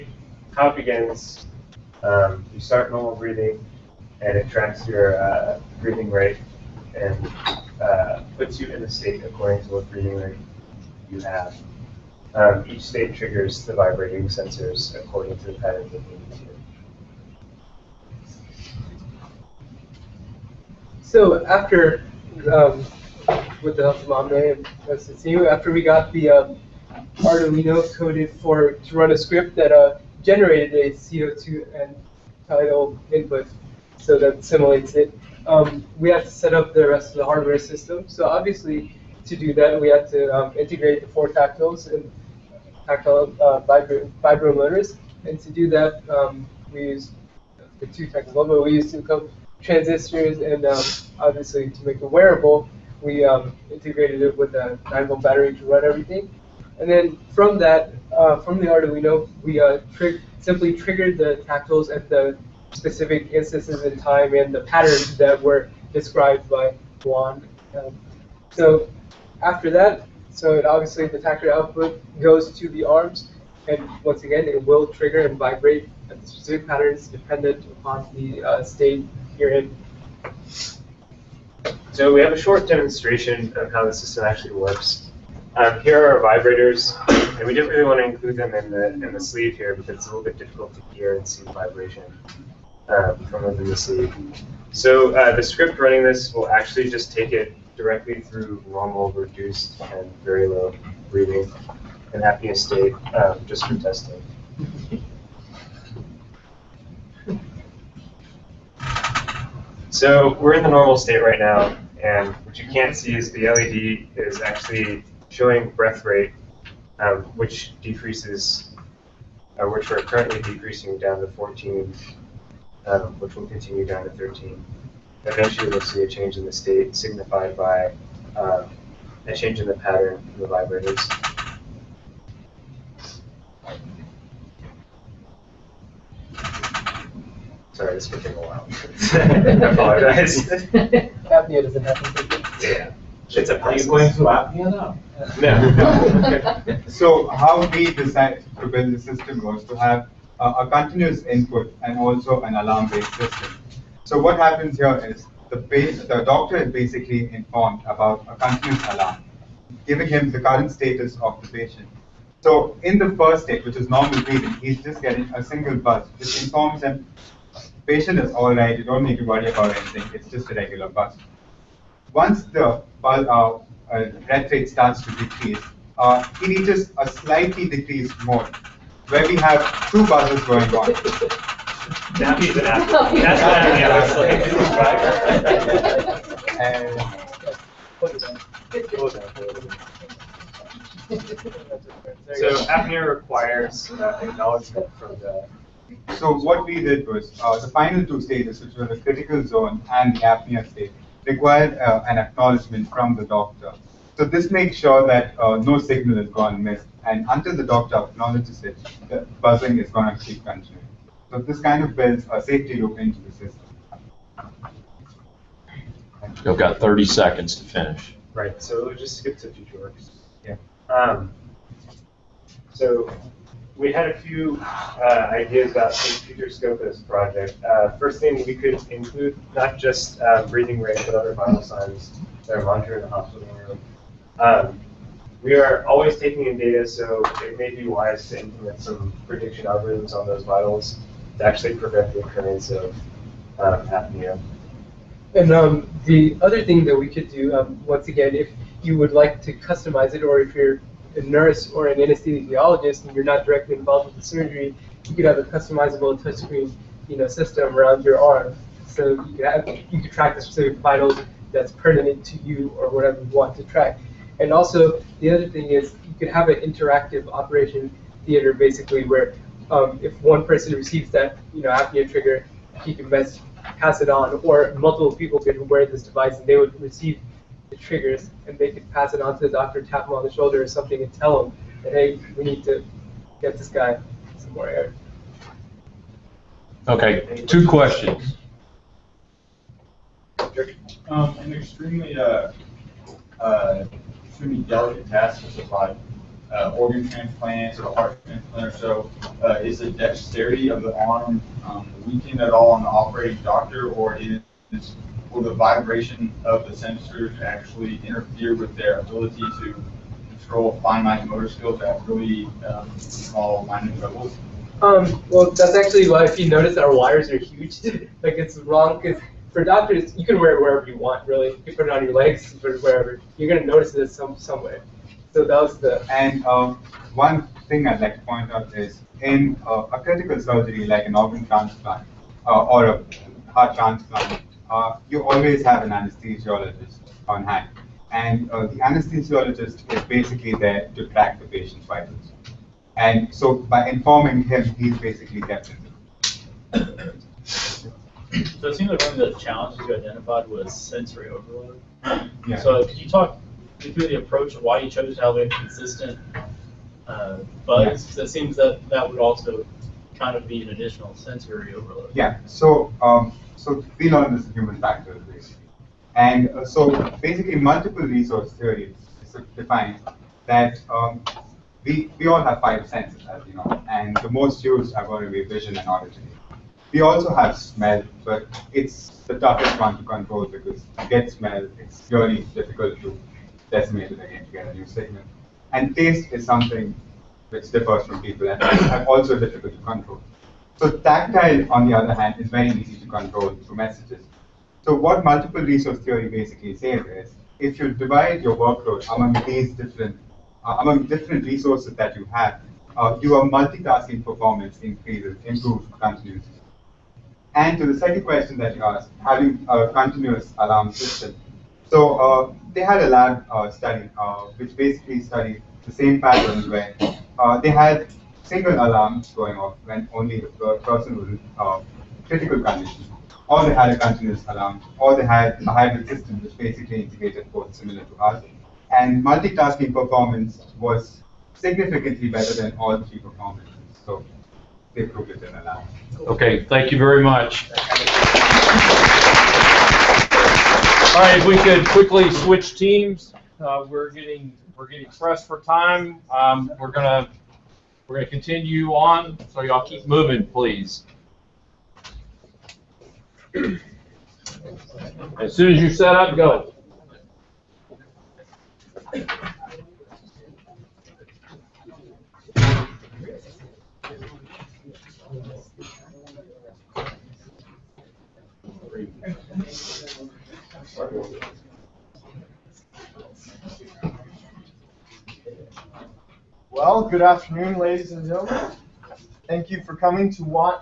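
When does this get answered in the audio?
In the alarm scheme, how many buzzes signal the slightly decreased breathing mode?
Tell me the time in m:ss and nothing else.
2:59.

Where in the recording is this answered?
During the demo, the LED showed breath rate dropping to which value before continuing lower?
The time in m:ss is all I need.
2:01.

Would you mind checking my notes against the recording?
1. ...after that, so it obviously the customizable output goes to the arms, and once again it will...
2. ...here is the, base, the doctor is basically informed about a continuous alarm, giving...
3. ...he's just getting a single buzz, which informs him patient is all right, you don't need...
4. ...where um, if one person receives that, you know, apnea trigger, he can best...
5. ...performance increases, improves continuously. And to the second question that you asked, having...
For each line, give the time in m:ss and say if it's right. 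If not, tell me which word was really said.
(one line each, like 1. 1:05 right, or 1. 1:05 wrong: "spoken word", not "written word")
1. 1:09 wrong: "tactile", not "customizable"
2. 2:34 right
3. 2:44 right
4. 4:29 right
5. 6:44 right.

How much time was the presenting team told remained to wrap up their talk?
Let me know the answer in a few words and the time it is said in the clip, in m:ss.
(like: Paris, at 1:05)
30 seconds, at 3:36.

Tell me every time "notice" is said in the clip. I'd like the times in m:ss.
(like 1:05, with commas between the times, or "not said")
5:16, 5:23.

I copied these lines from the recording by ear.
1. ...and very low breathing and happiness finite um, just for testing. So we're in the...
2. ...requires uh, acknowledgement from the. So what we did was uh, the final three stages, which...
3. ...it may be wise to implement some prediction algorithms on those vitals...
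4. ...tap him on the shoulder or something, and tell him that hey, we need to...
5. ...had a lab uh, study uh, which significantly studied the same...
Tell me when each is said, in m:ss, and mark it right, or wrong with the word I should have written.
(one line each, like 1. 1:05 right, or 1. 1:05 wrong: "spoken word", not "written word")
1. 1:39 wrong: "state", not "finite"
2. 3:13 wrong: "two", not "three"
3. 3:57 right
4. 4:39 right
5. 6:52 wrong: "basically", not "significantly".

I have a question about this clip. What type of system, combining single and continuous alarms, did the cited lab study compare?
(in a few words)
Hybrid system.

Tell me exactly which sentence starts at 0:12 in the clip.
Um, each state triggers the vibrating sensors according to the pattern that we need to.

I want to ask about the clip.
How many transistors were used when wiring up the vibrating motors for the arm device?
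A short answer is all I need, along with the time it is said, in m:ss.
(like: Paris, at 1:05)
2, at 0:48.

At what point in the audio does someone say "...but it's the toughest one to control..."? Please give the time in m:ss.
6:18.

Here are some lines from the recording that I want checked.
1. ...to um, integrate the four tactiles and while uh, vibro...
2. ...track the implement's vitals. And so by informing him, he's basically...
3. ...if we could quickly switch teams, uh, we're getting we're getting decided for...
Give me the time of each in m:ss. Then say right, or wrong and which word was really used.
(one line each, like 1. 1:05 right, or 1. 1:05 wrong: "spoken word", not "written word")
1. 0:40 wrong: "tactile", not "while"
2. 5:41 wrong: "patient", not "implement"
3. 7:21 wrong: "pressed", not "decided".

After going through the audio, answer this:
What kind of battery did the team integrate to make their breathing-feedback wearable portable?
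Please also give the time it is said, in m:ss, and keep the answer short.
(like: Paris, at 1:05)
9 volt battery, at 0:54.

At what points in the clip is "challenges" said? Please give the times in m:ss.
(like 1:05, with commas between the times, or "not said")
5:49.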